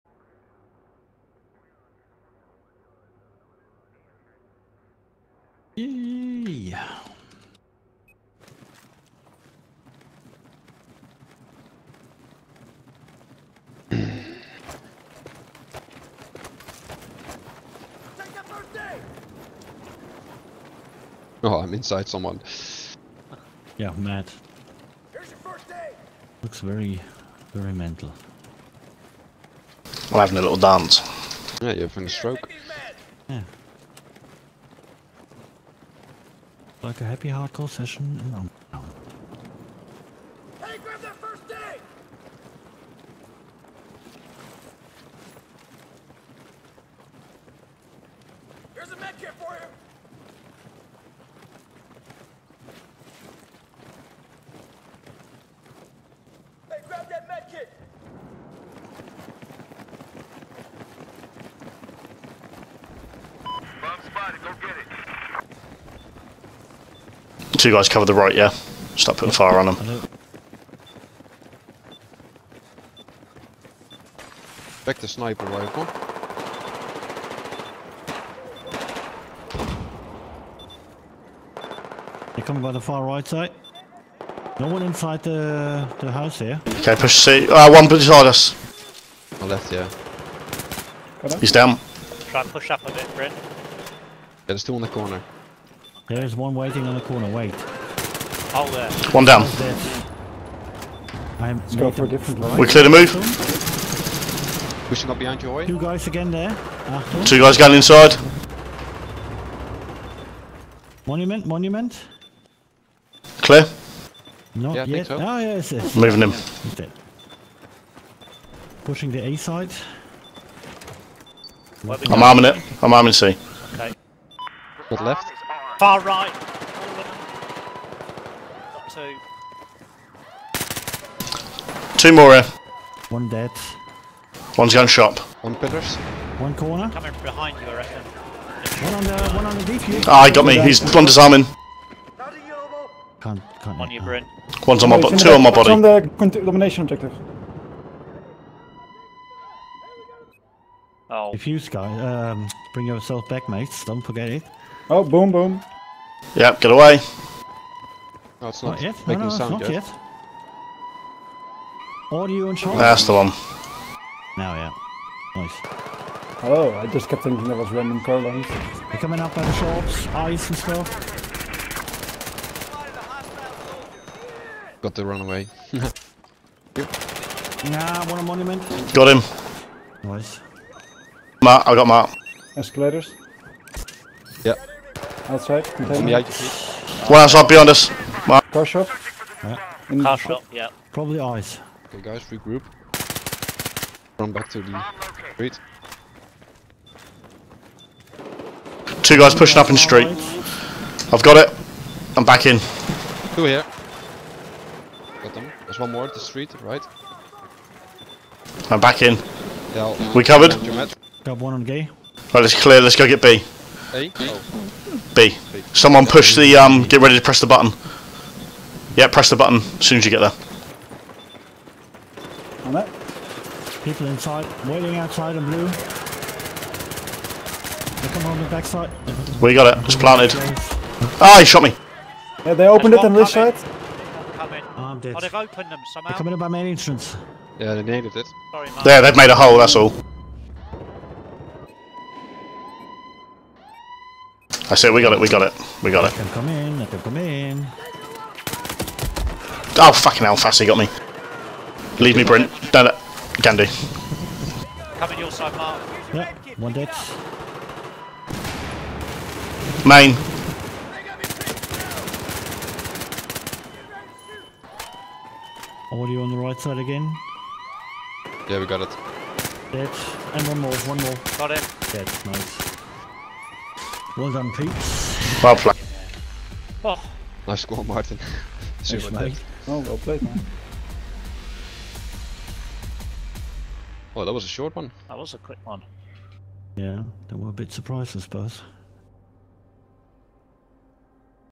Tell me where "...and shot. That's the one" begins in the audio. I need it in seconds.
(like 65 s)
162 s.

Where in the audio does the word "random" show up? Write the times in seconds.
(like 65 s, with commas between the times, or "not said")
167 s.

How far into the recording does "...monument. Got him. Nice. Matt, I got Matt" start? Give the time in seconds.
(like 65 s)
178 s.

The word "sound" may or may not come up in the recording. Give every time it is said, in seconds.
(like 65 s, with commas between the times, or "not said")
159 s.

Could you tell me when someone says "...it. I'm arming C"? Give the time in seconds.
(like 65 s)
122 s.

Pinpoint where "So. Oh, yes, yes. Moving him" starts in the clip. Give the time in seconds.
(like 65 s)
115 s.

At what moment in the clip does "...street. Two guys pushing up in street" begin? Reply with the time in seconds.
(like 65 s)
195 s.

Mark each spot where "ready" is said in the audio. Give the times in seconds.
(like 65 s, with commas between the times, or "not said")
217 s.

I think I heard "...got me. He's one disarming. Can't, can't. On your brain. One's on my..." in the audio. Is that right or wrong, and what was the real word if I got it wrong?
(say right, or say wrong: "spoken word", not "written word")
right.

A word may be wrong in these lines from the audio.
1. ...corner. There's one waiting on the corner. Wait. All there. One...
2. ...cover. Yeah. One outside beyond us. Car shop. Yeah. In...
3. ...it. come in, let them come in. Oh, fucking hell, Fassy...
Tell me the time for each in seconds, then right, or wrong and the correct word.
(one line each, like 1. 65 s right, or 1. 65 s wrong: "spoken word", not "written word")
1. 94 s right
2. 185 s wrong: "container", not "cover"
3. 246 s right.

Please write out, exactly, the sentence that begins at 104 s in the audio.
We should up behind your way.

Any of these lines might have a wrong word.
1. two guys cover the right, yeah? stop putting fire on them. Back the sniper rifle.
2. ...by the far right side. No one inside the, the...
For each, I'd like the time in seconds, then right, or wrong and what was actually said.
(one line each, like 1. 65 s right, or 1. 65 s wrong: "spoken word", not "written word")
1. 67 s right
2. 82 s right.